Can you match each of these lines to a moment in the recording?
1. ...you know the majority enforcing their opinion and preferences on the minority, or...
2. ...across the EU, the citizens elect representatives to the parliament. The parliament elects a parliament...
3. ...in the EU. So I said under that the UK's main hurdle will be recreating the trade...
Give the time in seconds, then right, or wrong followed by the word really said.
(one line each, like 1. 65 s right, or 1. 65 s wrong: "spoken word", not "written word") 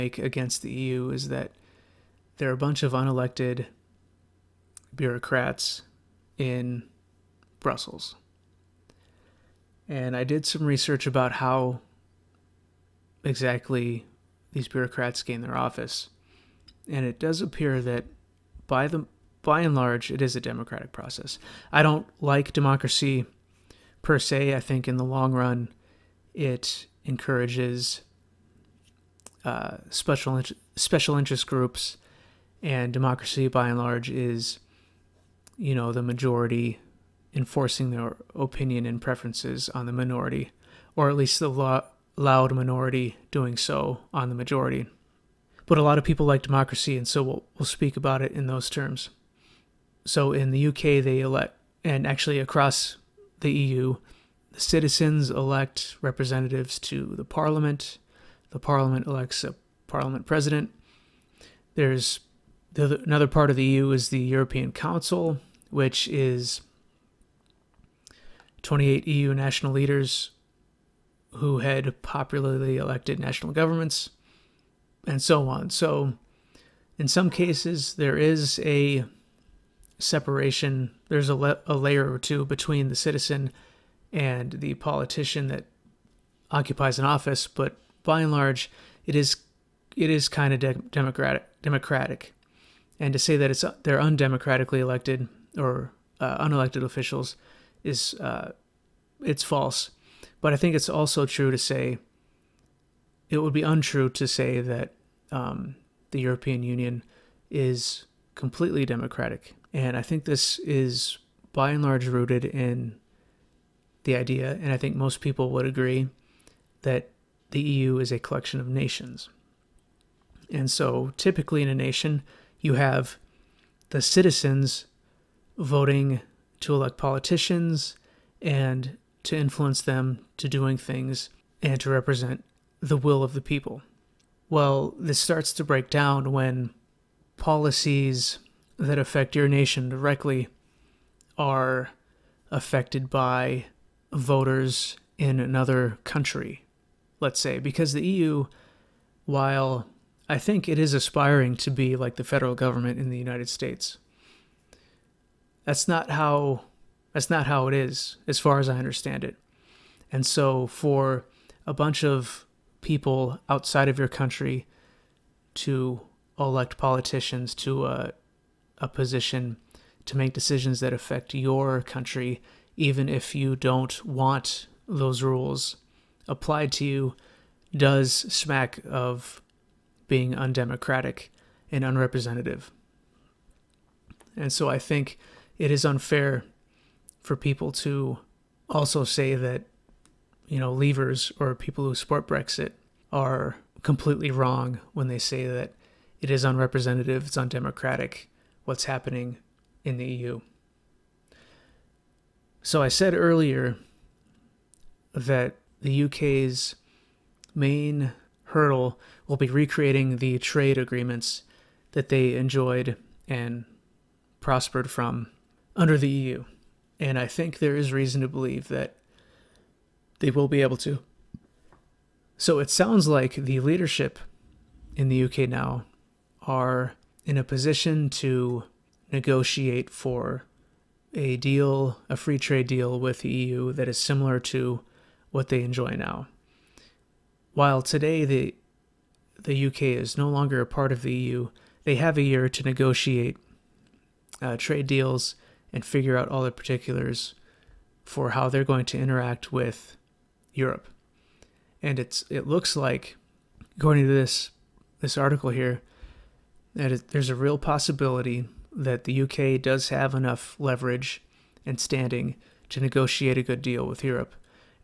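1. 35 s right
2. 52 s right
3. 199 s wrong: "earlier", not "under".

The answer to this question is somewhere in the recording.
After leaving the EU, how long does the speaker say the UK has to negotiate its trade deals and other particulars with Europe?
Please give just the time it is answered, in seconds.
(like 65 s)
242 s.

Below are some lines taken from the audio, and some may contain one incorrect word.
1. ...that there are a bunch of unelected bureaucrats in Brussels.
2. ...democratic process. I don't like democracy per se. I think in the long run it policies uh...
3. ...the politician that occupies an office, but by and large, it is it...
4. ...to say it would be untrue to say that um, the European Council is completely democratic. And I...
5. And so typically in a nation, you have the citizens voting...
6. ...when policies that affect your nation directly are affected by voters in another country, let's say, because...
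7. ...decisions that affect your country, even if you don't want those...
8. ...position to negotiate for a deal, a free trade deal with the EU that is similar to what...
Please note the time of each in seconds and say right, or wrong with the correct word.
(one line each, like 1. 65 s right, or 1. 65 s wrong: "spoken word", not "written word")
1. 1 s right
2. 20 s wrong: "encourages", not "policies"
3. 84 s right
4. 101 s wrong: "Union", not "Council"
5. 120 s right
6. 136 s right
7. 170 s right
8. 227 s right.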